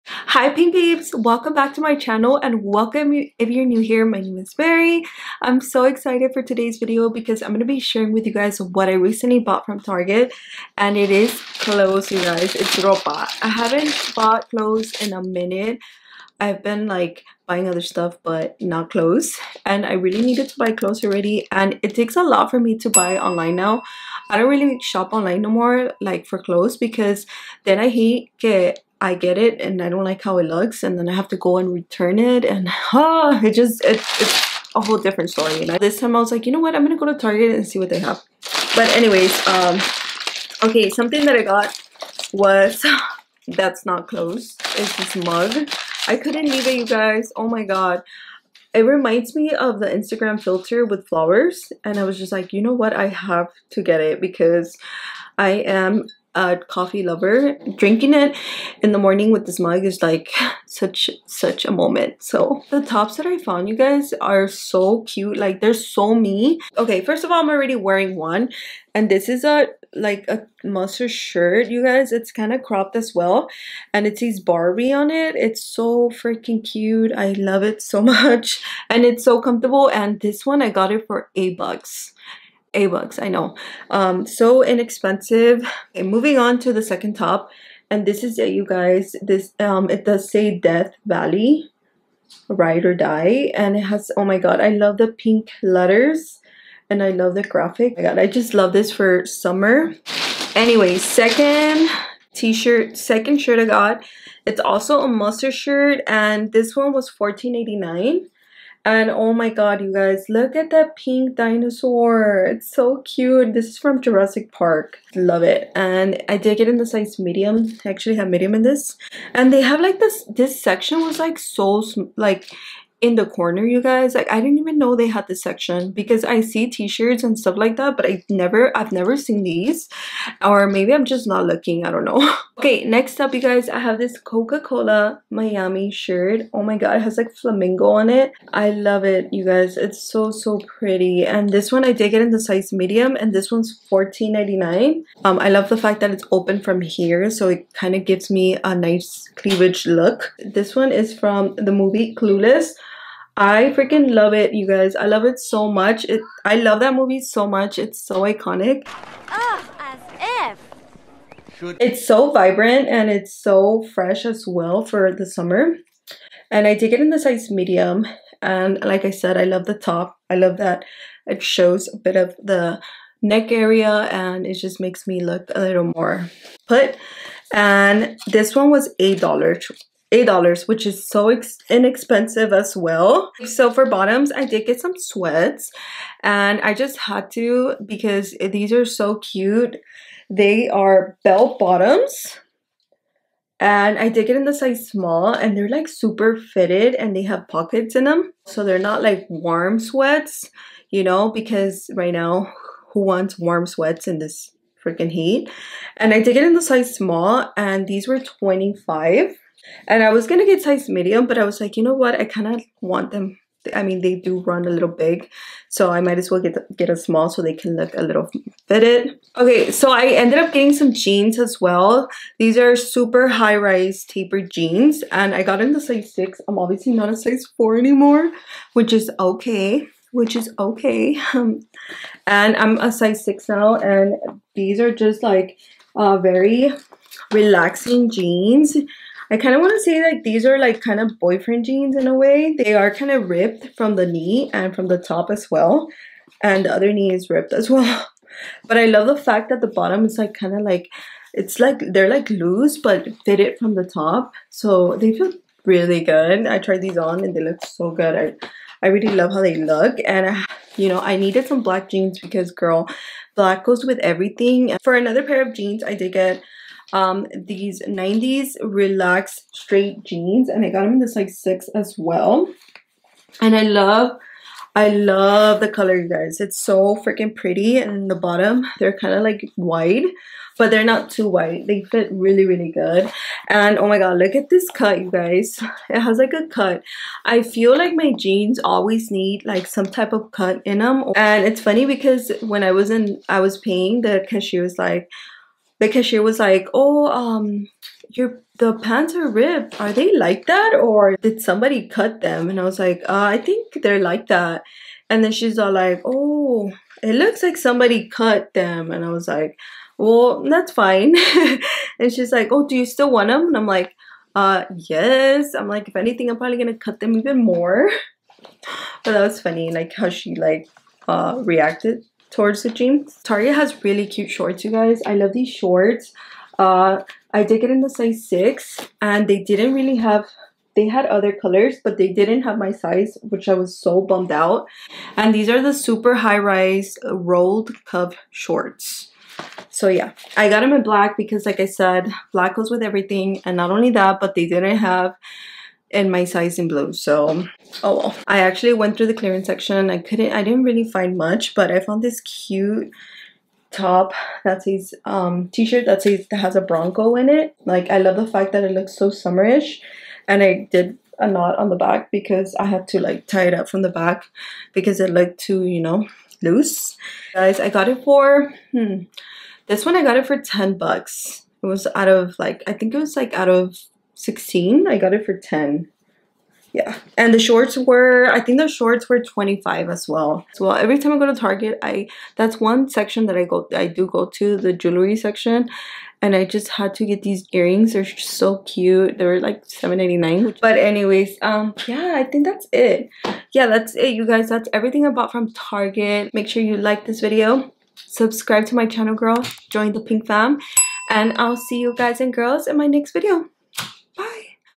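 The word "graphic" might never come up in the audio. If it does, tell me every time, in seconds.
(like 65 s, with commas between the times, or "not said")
97 s.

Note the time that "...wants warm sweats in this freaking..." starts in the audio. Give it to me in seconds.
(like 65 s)
203 s.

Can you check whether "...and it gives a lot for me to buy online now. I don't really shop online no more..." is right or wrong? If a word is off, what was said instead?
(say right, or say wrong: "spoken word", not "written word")
wrong: "takes", not "gives".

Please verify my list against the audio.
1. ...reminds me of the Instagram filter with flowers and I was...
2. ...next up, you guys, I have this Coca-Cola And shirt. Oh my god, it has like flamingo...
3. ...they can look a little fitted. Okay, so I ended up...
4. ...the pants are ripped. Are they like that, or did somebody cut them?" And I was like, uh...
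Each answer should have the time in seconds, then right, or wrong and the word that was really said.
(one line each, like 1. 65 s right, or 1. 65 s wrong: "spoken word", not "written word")
1. 48 s right
2. 132 s wrong: "Miami", not "And"
3. 217 s right
4. 298 s right.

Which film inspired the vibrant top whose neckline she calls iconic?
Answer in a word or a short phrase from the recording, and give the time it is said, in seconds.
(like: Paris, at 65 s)
Clueless, at 152 s.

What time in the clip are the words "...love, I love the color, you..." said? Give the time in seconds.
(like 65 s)
273 s.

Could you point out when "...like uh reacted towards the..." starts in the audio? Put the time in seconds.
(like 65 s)
320 s.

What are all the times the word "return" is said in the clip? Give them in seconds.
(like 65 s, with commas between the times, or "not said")
31 s.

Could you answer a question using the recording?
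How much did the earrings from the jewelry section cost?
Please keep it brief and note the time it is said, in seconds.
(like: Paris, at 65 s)
$7.89, at 389 s.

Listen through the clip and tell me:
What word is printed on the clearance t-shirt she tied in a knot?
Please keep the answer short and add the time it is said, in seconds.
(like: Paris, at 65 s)
bronco, at 356 s.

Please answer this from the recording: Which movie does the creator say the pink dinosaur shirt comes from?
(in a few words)
Jurassic Park.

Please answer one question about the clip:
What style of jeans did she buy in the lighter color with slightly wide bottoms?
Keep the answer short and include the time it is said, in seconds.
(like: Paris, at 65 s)
90s relaxed straight, at 267 s.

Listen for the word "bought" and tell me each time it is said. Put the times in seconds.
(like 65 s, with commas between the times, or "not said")
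9 s, 14 s, 395 s.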